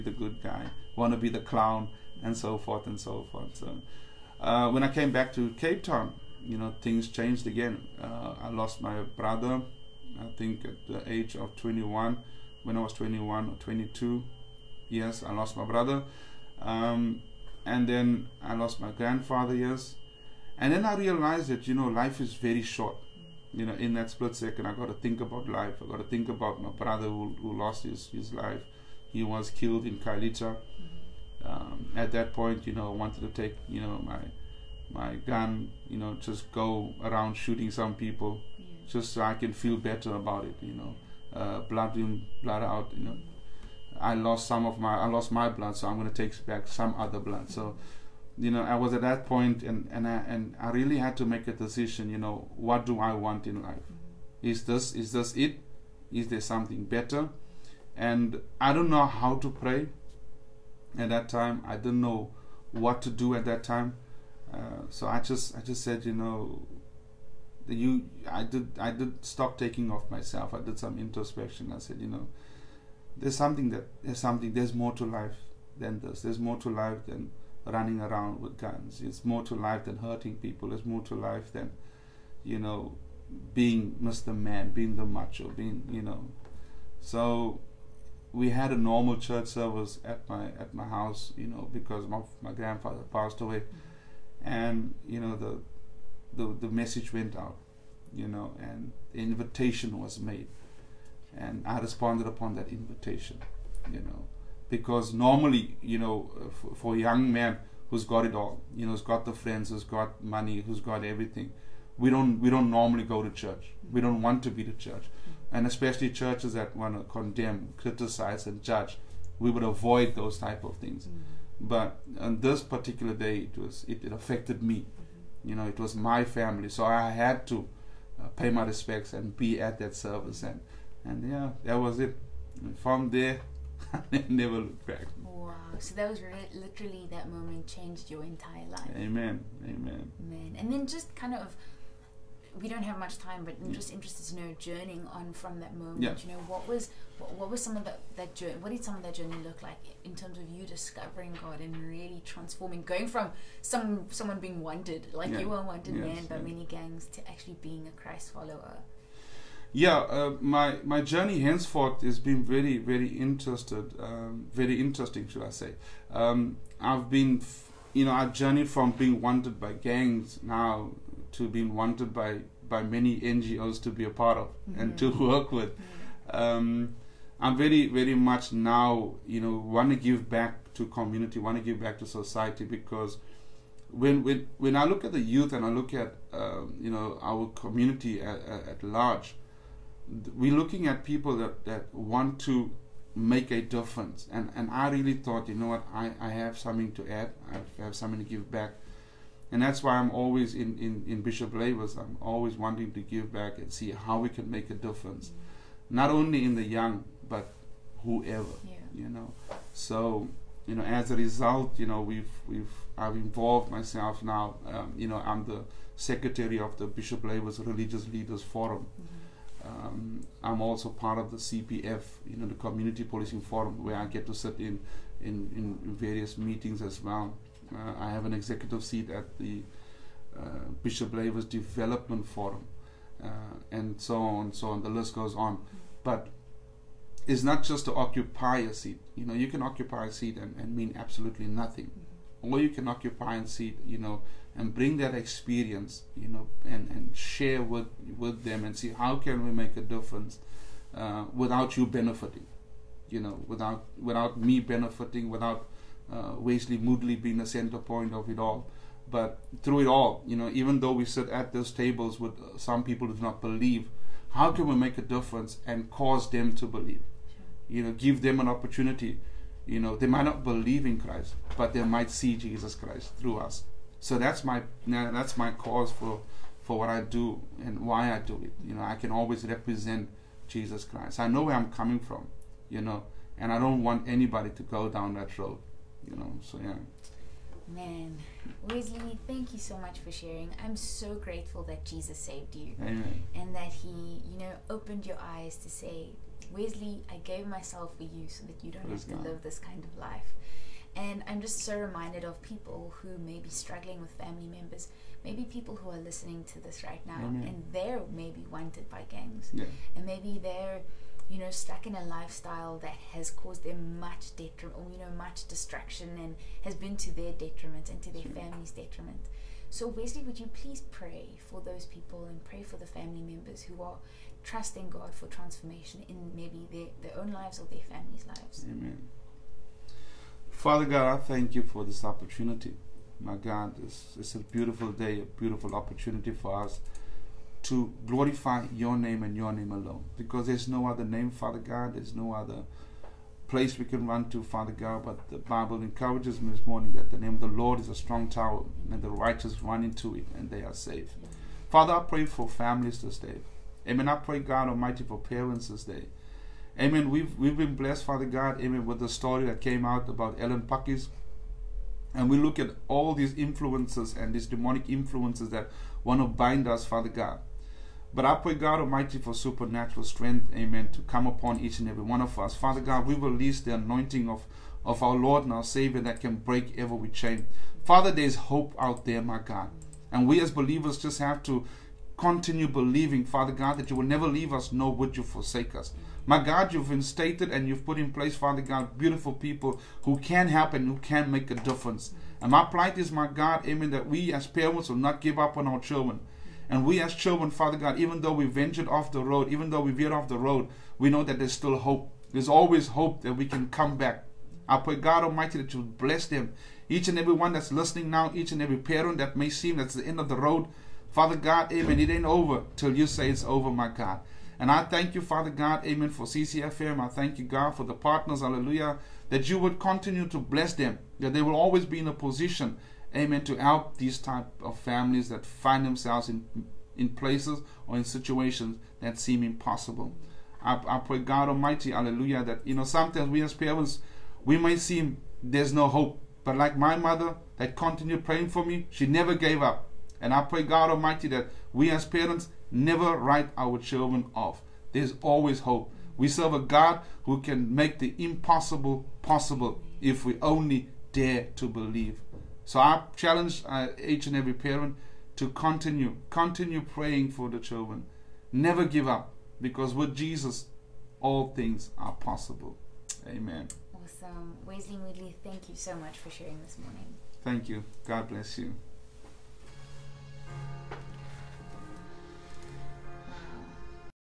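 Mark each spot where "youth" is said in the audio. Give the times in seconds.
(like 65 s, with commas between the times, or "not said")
185 s.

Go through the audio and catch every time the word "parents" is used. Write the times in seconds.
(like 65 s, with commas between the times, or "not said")
355 s, 394 s, 408 s, 433 s, 442 s, 454 s.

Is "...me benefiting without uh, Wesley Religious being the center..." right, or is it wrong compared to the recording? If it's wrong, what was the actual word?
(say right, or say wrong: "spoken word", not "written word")
wrong: "Moodley", not "Religious".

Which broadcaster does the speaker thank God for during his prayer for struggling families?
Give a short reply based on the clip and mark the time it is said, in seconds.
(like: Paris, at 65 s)
CCFM, at 416 s.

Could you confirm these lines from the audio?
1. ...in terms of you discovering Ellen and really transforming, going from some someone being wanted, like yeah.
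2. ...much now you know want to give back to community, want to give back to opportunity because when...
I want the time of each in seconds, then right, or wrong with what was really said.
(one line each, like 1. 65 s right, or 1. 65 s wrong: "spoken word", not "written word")
1. 150 s wrong: "God", not "Ellen"
2. 178 s wrong: "society", not "opportunity".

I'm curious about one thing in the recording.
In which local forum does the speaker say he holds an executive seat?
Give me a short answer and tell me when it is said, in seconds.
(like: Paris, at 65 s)
Bishop Lavis Development Forum, at 230 s.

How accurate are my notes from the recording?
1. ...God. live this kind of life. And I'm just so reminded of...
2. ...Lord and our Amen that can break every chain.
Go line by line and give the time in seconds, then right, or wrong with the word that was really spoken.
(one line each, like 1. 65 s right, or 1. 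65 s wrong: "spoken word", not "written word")
1. 299 s right
2. 375 s wrong: "Savior", not "Amen".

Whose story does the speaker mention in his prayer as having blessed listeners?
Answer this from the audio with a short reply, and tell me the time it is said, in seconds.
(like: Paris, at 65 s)
Ellen Pakkies, at 360 s.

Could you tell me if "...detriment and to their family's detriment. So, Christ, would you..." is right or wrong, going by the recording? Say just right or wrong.
wrong.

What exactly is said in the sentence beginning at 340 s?
Because there's no other name, Father God.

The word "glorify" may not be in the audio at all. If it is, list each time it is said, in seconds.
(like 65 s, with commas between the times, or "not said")
338 s.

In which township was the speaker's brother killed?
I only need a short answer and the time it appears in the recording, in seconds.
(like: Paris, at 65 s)
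Khayelitsha, at 30 s.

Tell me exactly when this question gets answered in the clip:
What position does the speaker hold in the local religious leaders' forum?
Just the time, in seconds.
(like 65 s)
215 s.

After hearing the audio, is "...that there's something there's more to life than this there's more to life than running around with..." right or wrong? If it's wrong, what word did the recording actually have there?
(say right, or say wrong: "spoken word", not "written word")
right.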